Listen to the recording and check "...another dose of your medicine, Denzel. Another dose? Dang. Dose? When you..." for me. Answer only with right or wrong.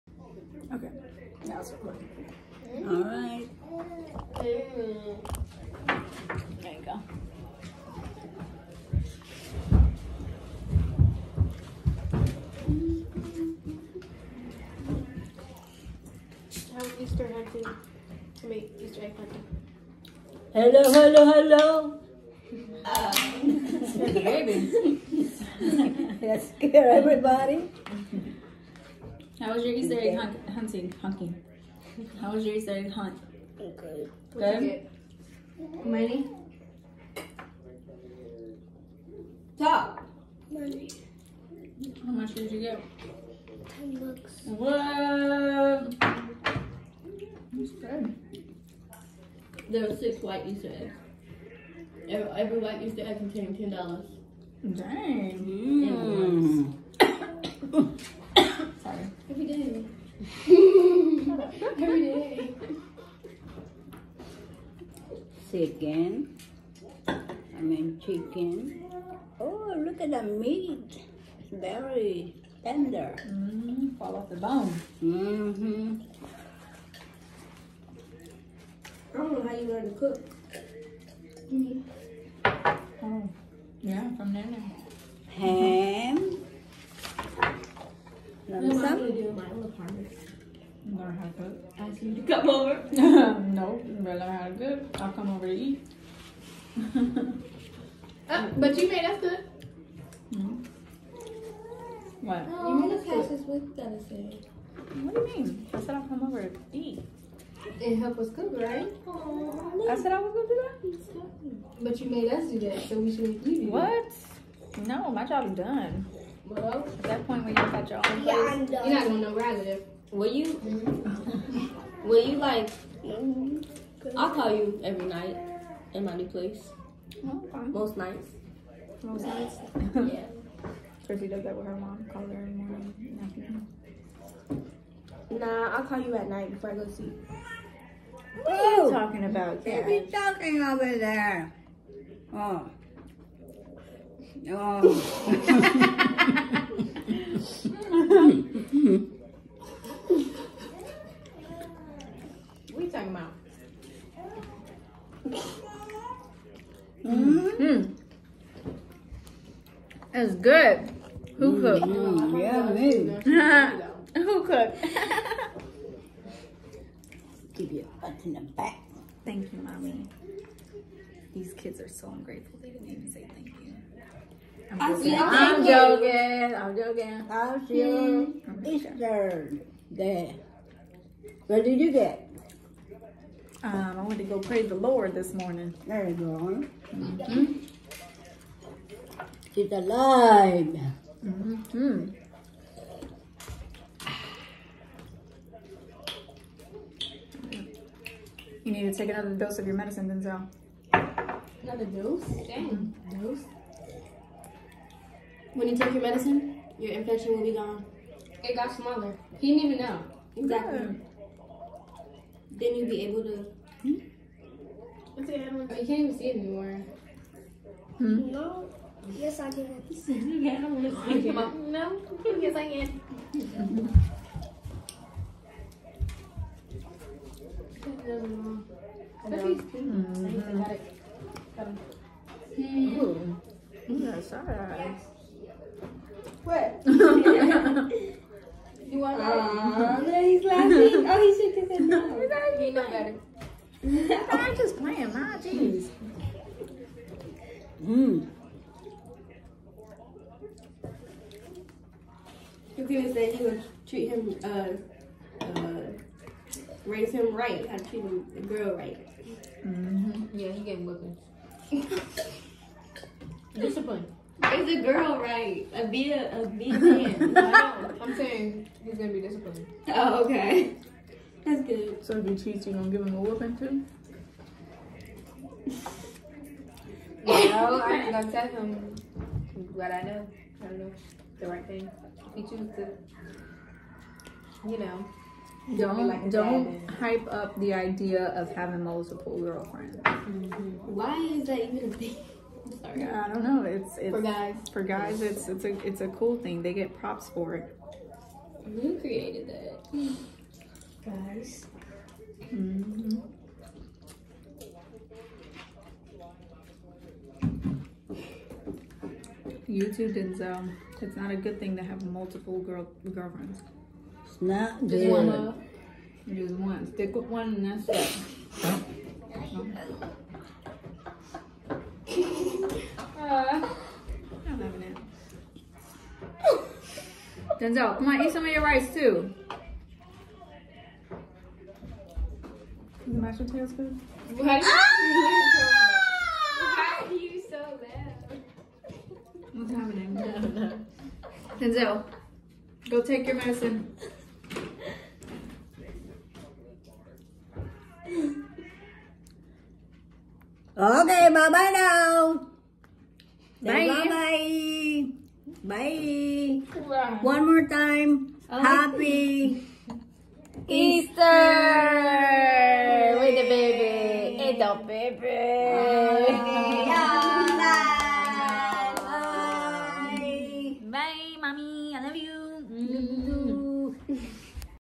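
right.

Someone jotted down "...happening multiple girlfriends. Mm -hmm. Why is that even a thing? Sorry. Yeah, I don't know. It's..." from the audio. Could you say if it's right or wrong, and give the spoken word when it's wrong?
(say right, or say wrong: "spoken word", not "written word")
wrong: "having", not "happening".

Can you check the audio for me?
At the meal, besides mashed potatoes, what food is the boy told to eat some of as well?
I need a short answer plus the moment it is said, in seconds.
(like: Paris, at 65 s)
rice, at 328 s.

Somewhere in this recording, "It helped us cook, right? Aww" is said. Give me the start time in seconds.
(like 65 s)
107 s.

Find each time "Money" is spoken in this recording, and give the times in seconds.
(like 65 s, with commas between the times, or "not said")
35 s, 40 s.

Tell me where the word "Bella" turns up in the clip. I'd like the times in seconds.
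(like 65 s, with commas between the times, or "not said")
93 s.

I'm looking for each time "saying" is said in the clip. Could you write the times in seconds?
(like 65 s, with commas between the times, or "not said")
268 s.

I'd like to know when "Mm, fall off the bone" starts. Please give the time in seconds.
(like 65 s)
73 s.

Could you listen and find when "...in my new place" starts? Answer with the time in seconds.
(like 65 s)
125 s.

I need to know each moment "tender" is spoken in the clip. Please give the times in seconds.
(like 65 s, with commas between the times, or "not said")
72 s.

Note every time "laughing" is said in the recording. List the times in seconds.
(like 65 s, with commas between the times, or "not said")
240 s.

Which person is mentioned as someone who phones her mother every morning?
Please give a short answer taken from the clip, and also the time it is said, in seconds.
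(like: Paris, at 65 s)
Chrissy, at 131 s.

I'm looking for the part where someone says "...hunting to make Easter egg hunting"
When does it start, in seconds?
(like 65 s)
17 s.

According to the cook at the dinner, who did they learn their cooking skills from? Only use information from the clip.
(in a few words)
Nana.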